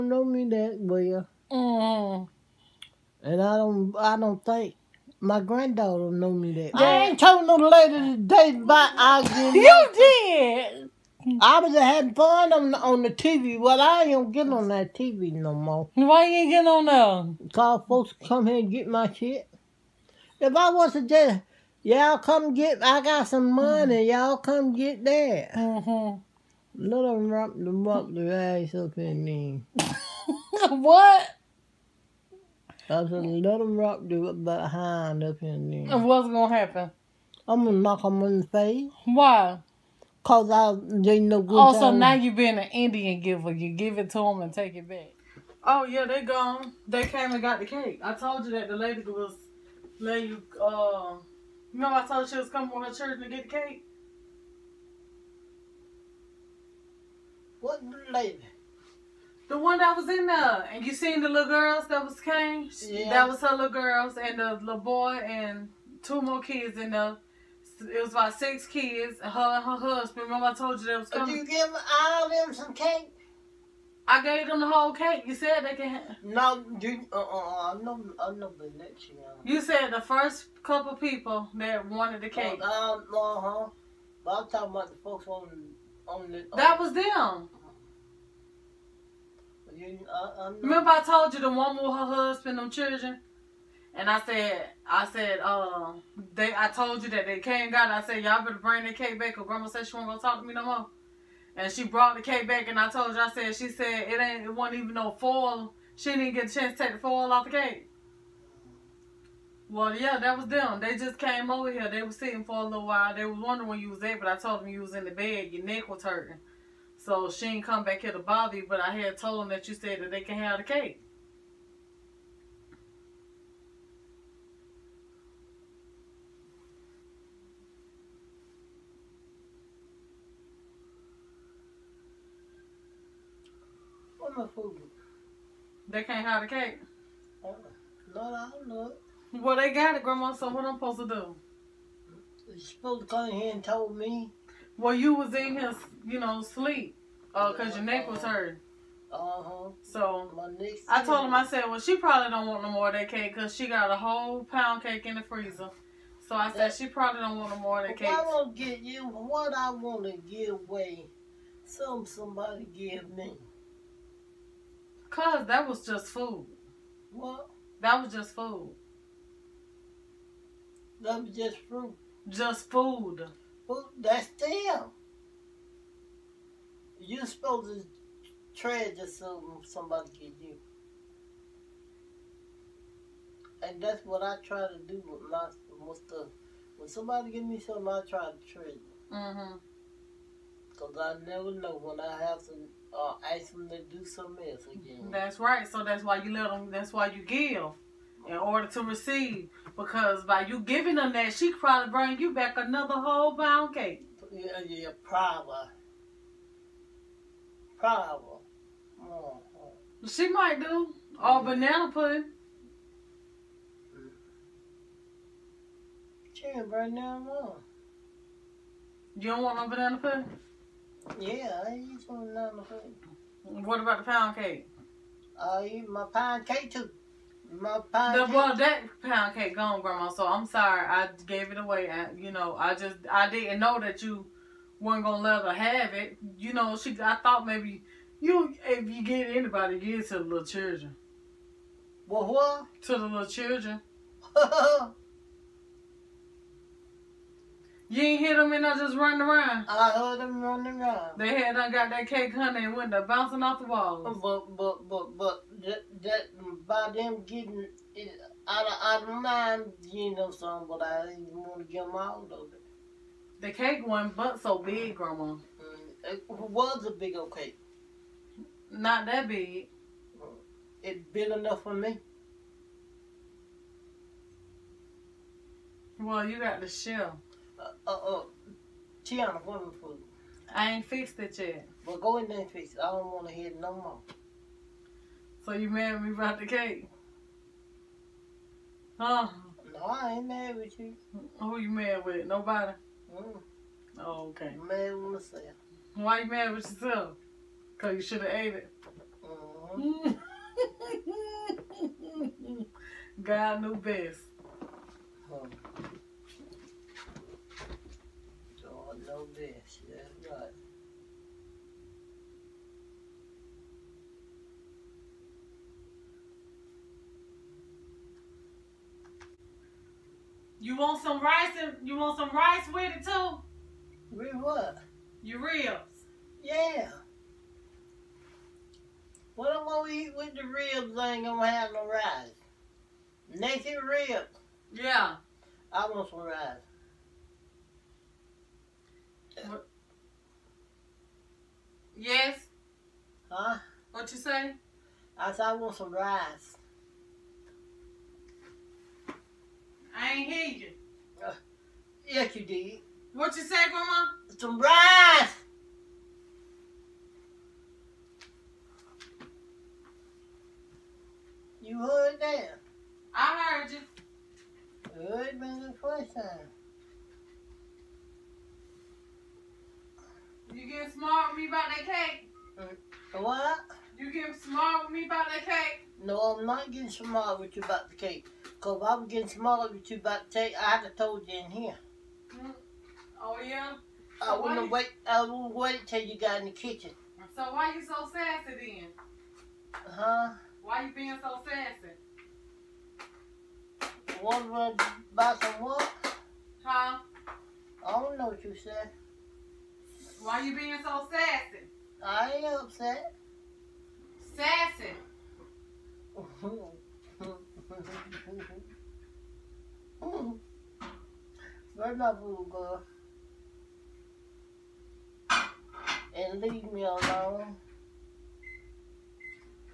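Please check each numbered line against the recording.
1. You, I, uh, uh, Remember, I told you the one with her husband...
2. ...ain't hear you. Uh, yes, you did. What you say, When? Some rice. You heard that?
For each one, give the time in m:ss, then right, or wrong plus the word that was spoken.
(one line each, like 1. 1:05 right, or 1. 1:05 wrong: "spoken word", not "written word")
1. 1:29 right
2. 5:50 wrong: "Grandma", not "When".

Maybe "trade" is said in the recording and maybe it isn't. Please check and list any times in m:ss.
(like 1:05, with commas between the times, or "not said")
2:58, 3:08.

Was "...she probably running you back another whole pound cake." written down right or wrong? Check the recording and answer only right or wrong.
wrong.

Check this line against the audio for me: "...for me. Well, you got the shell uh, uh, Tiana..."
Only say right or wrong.
right.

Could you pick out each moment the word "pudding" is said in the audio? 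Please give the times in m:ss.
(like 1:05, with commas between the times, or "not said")
3:31, 3:39.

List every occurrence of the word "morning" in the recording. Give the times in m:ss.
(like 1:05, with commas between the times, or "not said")
not said.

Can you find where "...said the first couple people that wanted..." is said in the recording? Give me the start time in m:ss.
1:19.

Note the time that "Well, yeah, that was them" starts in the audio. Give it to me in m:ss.
1:49.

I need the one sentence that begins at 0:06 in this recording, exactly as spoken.
I ain't told no lady today about I get You did.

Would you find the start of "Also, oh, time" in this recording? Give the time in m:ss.
0:41.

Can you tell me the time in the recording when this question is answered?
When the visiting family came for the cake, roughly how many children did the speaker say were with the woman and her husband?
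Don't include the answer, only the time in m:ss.
1:08.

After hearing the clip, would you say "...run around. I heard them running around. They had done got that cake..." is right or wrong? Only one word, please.
right.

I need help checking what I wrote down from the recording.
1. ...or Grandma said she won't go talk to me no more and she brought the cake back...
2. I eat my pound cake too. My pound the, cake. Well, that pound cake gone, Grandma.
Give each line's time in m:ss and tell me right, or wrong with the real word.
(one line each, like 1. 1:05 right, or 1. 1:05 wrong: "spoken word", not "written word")
1. 1:39 right
2. 3:45 right.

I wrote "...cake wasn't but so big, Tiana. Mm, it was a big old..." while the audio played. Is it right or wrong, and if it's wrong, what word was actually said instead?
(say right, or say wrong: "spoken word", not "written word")
wrong: "Grandma", not "Tiana".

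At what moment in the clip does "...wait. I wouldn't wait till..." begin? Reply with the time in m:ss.
6:24.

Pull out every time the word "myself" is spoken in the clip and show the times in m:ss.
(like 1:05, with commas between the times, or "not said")
4:55.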